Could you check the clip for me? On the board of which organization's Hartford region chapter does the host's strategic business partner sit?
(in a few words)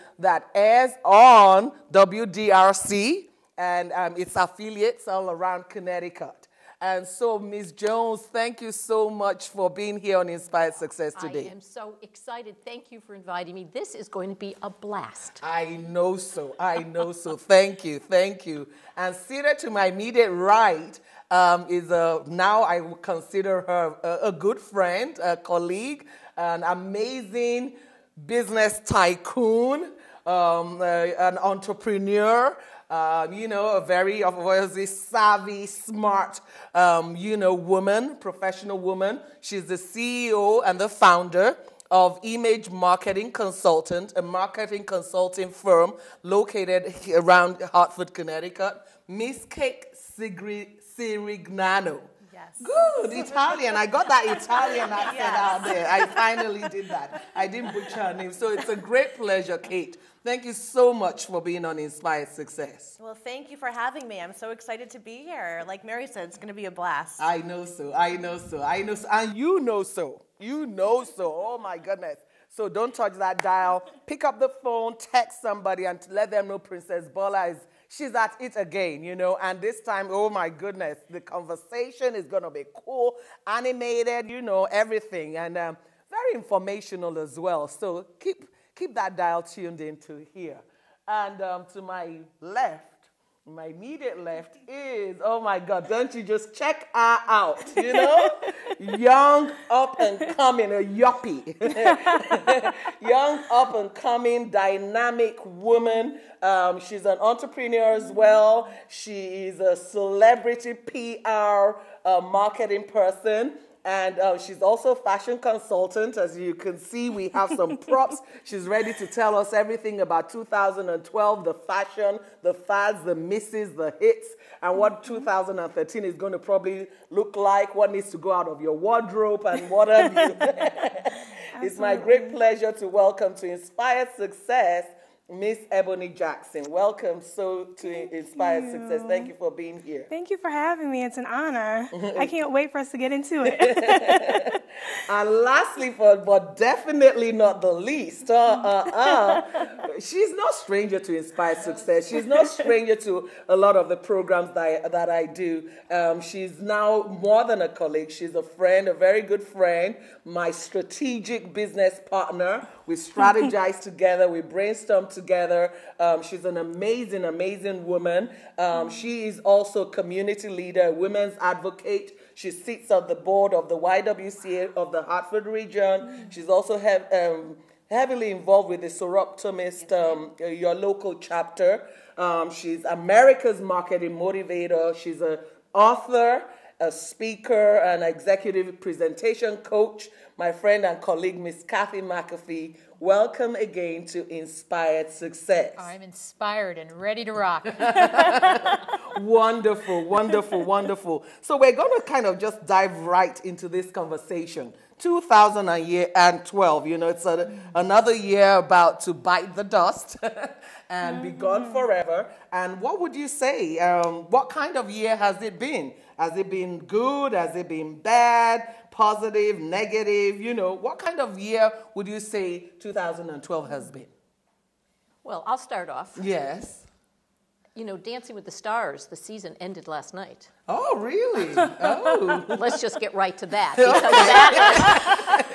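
YWCA.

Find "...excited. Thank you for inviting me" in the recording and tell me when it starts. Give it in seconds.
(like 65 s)
12 s.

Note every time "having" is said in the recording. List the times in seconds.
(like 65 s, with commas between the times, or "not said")
63 s, 140 s.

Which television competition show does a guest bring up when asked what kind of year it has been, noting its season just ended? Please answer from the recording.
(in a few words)
Dancing with the Stars.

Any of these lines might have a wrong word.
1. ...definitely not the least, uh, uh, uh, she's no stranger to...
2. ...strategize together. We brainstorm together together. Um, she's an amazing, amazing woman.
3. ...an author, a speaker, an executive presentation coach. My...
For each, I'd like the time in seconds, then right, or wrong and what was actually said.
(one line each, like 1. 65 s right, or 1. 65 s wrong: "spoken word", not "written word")
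1. 146 s right
2. 162 s right
3. 185 s right.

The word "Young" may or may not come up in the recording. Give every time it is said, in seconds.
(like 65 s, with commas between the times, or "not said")
98 s, 103 s.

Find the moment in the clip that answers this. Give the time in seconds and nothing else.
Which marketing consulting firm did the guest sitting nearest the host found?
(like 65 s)
42 s.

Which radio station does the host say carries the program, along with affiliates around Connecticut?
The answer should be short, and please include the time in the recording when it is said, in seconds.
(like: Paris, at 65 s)
WDRC, at 1 s.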